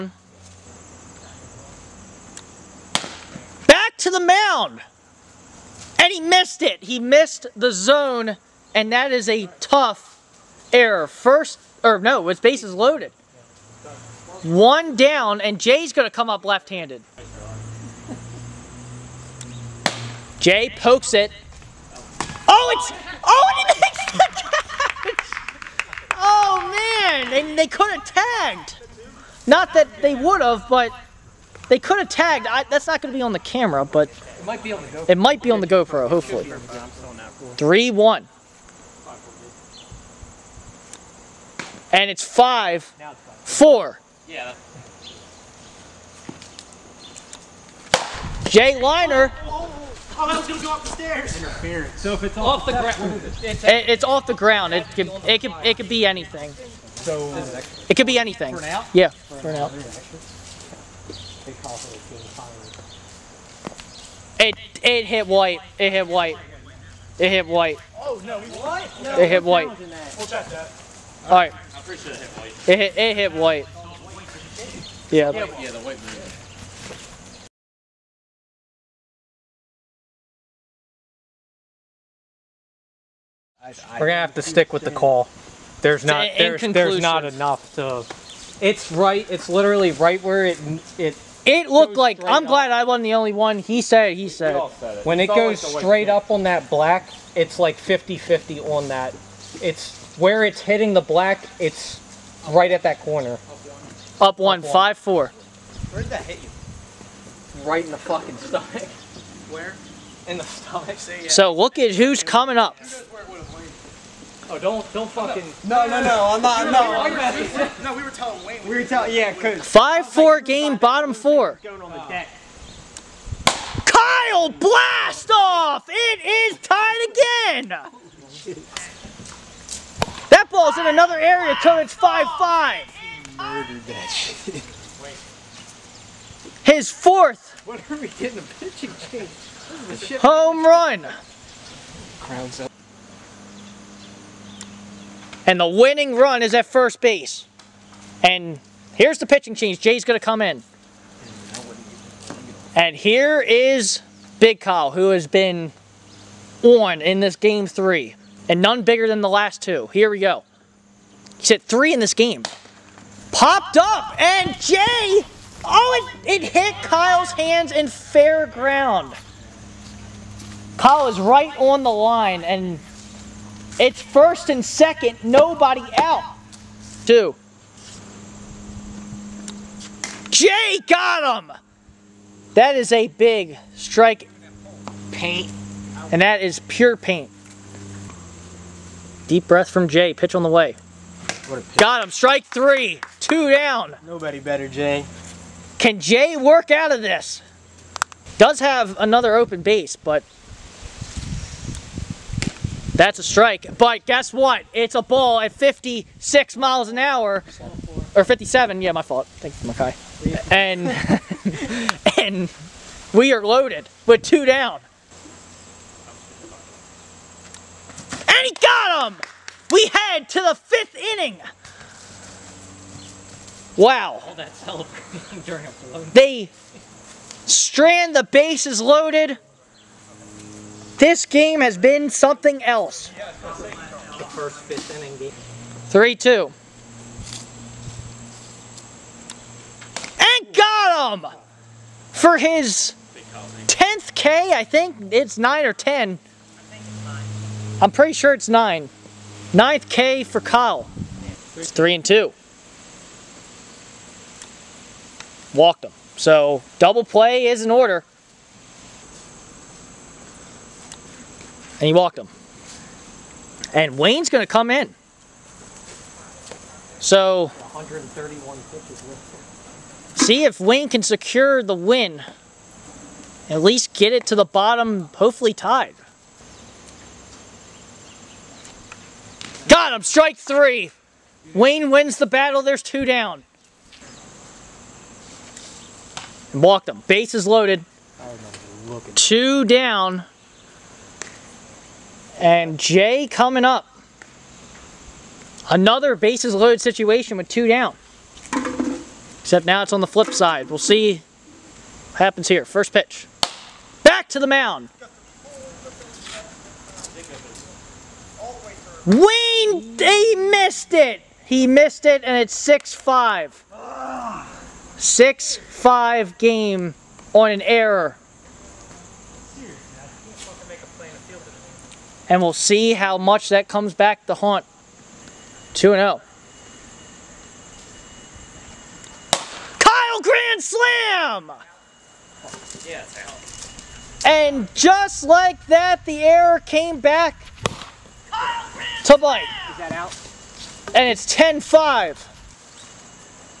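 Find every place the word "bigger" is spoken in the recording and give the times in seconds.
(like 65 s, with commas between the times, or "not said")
158 s.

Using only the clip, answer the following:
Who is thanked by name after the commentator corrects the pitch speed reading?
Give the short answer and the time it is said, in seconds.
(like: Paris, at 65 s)
Makai, at 209 s.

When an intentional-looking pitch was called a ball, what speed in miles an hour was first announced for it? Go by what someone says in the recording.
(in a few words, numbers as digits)
56.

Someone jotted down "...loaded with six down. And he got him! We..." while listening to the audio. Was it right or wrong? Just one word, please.
wrong.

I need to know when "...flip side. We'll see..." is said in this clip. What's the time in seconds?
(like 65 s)
300 s.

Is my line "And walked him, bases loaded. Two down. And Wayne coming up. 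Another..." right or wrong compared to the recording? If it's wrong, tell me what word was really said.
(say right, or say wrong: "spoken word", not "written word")
wrong: "Jay", not "Wayne".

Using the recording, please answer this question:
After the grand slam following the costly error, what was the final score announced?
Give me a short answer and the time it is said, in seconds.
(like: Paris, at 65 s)
10-5, at 341 s.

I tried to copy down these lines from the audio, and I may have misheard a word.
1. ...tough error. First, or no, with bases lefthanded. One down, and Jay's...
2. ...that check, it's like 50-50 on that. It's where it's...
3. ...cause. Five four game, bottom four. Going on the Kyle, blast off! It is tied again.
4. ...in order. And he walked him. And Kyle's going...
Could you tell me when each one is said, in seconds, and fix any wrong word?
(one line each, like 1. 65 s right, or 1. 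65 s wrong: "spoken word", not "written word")
1. 9 s wrong: "loaded", not "lefthanded"
2. 96 s wrong: "black", not "check"
3. 119 s right
4. 257 s wrong: "Wayne", not "Kyle".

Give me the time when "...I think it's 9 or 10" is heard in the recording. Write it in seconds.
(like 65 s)
244 s.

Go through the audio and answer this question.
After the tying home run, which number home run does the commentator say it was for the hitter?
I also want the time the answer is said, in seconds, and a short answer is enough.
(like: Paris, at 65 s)
4th, at 136 s.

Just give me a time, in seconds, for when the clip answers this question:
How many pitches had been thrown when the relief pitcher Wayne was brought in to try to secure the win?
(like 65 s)
267 s.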